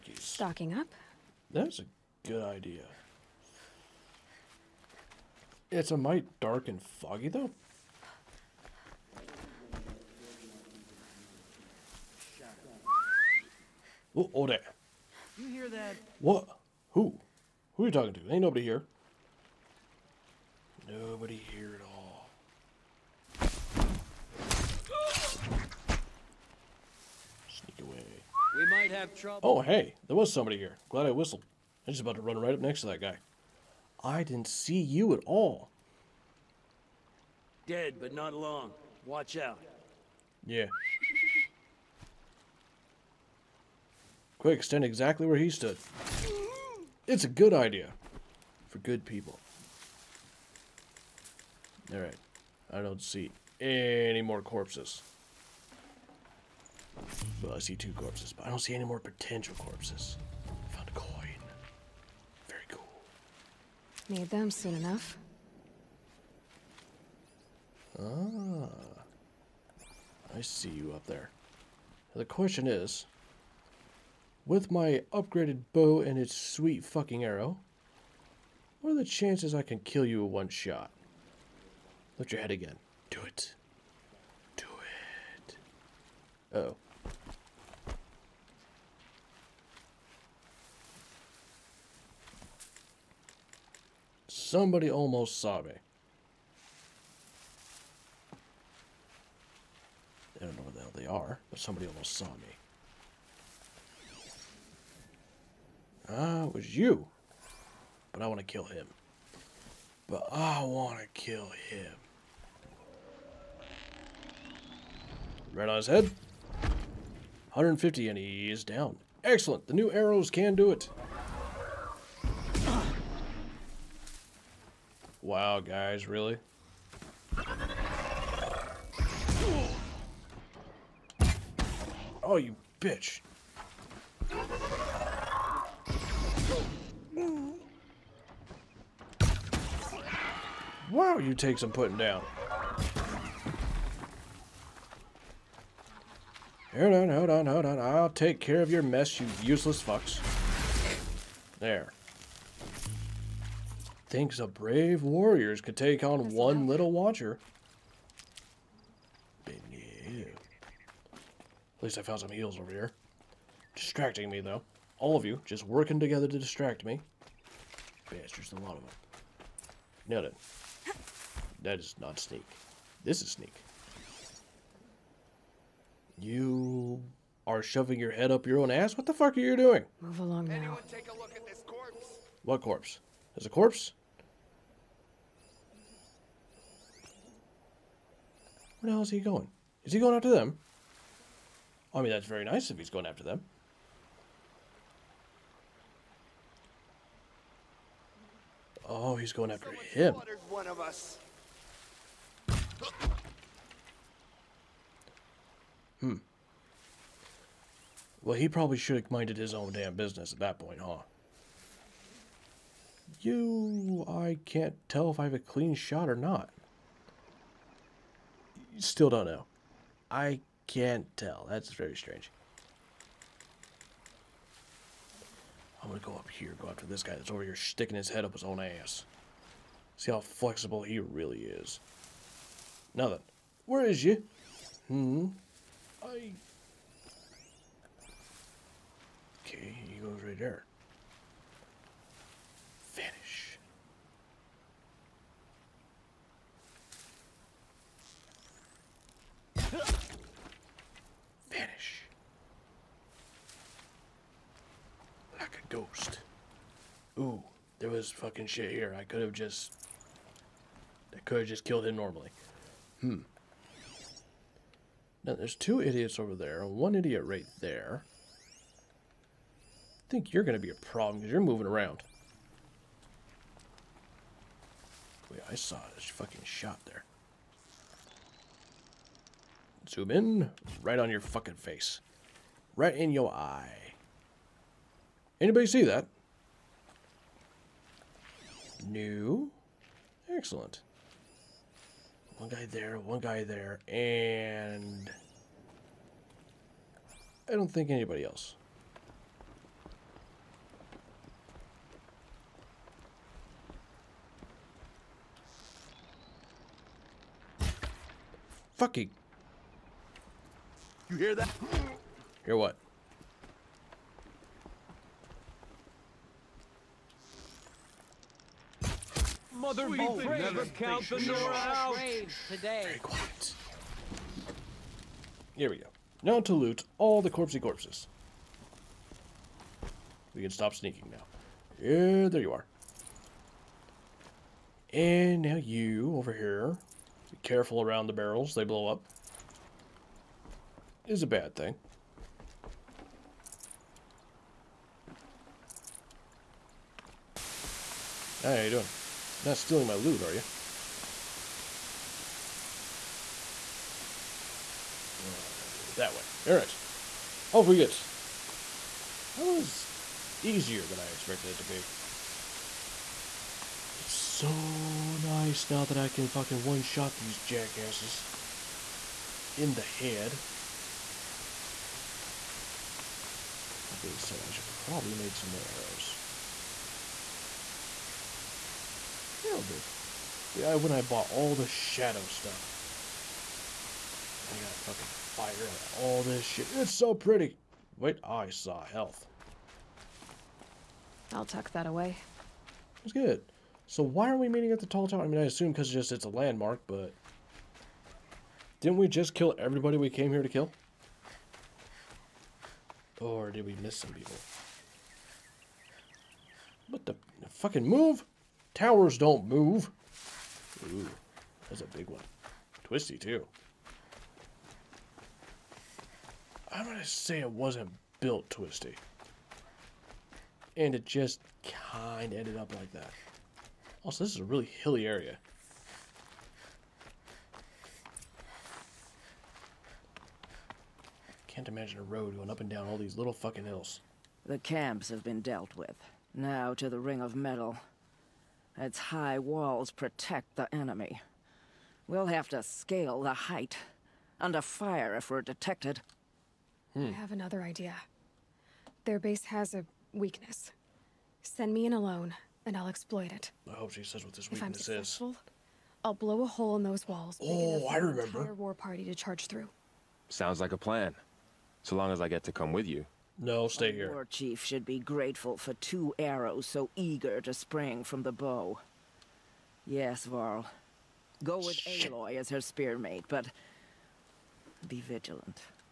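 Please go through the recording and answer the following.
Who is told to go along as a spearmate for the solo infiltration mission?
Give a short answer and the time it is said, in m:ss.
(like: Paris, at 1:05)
Varl, at 7:50.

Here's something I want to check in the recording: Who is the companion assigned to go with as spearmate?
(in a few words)
Aloy.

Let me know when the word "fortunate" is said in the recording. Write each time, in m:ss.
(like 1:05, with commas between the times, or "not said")
not said.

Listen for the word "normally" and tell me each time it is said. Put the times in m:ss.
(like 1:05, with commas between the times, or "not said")
4:21.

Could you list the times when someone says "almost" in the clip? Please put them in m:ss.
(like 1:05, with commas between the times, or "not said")
1:34, 1:41.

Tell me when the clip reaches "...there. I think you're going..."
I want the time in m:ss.
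4:27.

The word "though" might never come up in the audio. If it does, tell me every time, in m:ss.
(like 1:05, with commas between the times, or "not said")
0:07, 2:44.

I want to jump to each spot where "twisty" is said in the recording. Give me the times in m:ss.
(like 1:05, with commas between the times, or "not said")
6:52, 6:58.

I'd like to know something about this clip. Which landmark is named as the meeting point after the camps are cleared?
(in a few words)
The tall tower.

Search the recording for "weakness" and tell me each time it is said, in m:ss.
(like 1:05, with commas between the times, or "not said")
7:30, 7:34.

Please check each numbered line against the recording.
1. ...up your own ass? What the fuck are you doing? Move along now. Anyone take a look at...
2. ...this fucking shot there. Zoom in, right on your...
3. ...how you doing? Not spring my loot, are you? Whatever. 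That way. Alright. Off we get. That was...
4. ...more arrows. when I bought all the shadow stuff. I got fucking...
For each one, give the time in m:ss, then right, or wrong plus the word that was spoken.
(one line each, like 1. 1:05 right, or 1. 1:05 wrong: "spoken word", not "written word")
1. 2:58 right
2. 4:35 right
3. 5:48 wrong: "stealing", not "spring"
4. 6:15 right.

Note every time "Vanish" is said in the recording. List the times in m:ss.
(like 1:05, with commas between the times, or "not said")
4:02, 4:11.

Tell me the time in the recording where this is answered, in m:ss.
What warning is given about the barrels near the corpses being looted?
5:38.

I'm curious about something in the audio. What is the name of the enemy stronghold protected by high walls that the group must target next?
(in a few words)
Ring of Metal.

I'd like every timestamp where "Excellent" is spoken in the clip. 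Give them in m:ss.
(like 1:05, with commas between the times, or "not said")
1:59, 4:50.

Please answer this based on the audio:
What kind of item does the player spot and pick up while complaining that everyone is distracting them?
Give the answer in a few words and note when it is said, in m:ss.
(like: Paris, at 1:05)
Heels, at 2:42.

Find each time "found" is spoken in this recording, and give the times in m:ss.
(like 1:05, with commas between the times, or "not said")
1:00, 2:42.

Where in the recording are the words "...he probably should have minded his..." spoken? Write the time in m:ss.
3:28.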